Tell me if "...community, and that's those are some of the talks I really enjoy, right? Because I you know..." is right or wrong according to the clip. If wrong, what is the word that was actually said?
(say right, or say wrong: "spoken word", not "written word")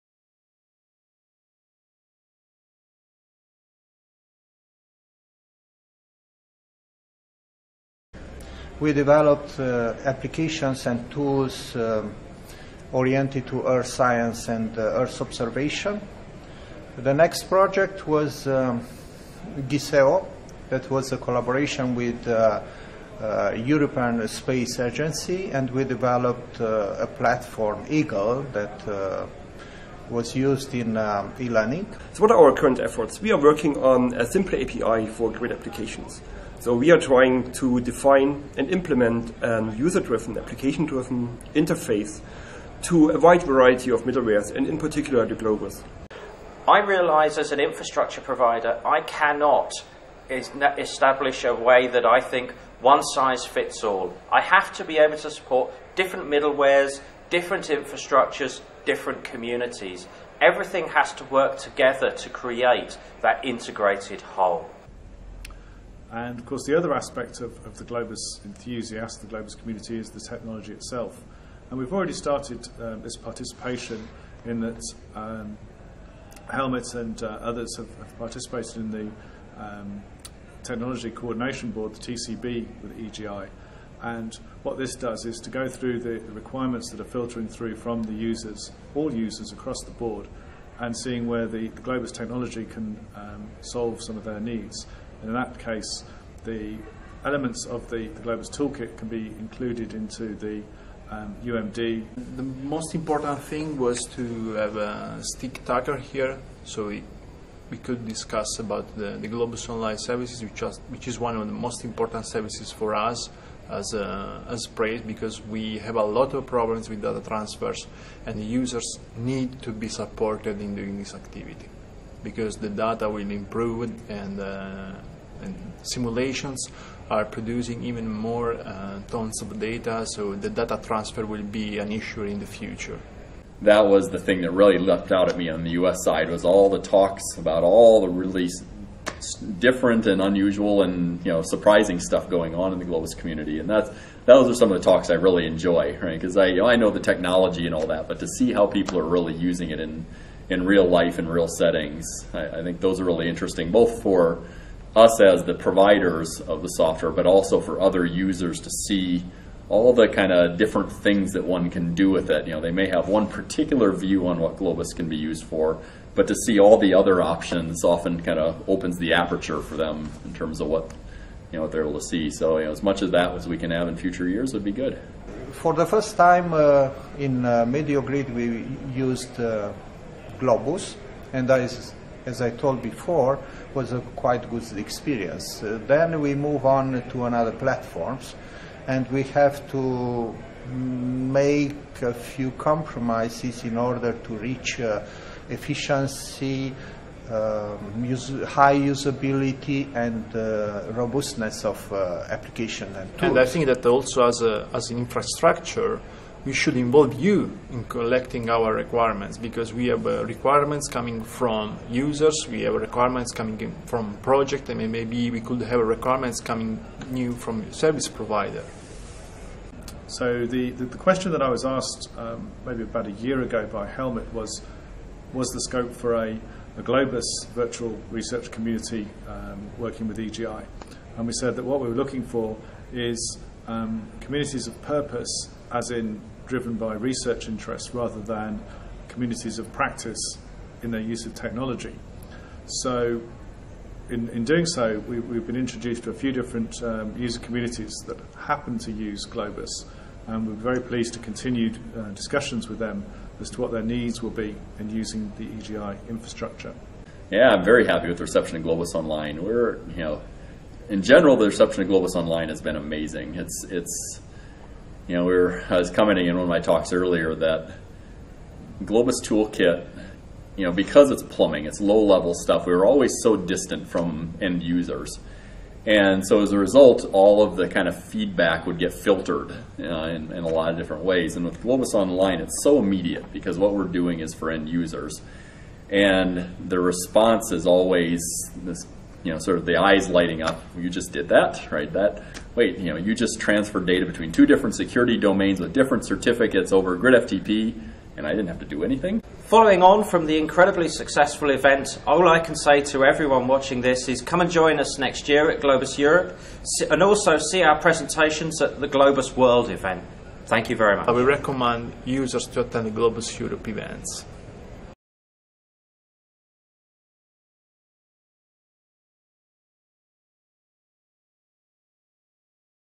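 right.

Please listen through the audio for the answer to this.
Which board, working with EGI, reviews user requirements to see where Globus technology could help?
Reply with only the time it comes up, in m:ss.
1:20.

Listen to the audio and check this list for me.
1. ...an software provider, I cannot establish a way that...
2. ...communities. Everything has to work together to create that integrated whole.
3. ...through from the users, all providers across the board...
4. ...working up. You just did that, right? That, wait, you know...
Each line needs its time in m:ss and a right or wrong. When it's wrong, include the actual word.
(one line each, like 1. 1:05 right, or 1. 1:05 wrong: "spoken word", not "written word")
1. 0:47 wrong: "infrastructure", not "software"
2. 0:59 right
3. 1:27 wrong: "users", not "providers"
4. 4:50 wrong: "lighting", not "working".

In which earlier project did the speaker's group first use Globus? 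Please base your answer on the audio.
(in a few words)
MedioGrid.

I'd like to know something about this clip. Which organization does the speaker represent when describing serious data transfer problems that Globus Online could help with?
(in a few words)
PRACE.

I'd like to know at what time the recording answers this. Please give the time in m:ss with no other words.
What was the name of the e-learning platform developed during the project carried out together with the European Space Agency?
0:27.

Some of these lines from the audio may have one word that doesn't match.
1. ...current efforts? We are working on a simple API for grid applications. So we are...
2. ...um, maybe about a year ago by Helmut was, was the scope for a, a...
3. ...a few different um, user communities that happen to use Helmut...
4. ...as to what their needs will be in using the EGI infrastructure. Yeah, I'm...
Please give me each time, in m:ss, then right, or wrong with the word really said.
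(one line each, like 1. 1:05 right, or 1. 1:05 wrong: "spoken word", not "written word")
1. 0:32 right
2. 3:42 right
3. 4:06 wrong: "Globus", not "Helmut"
4. 4:13 right.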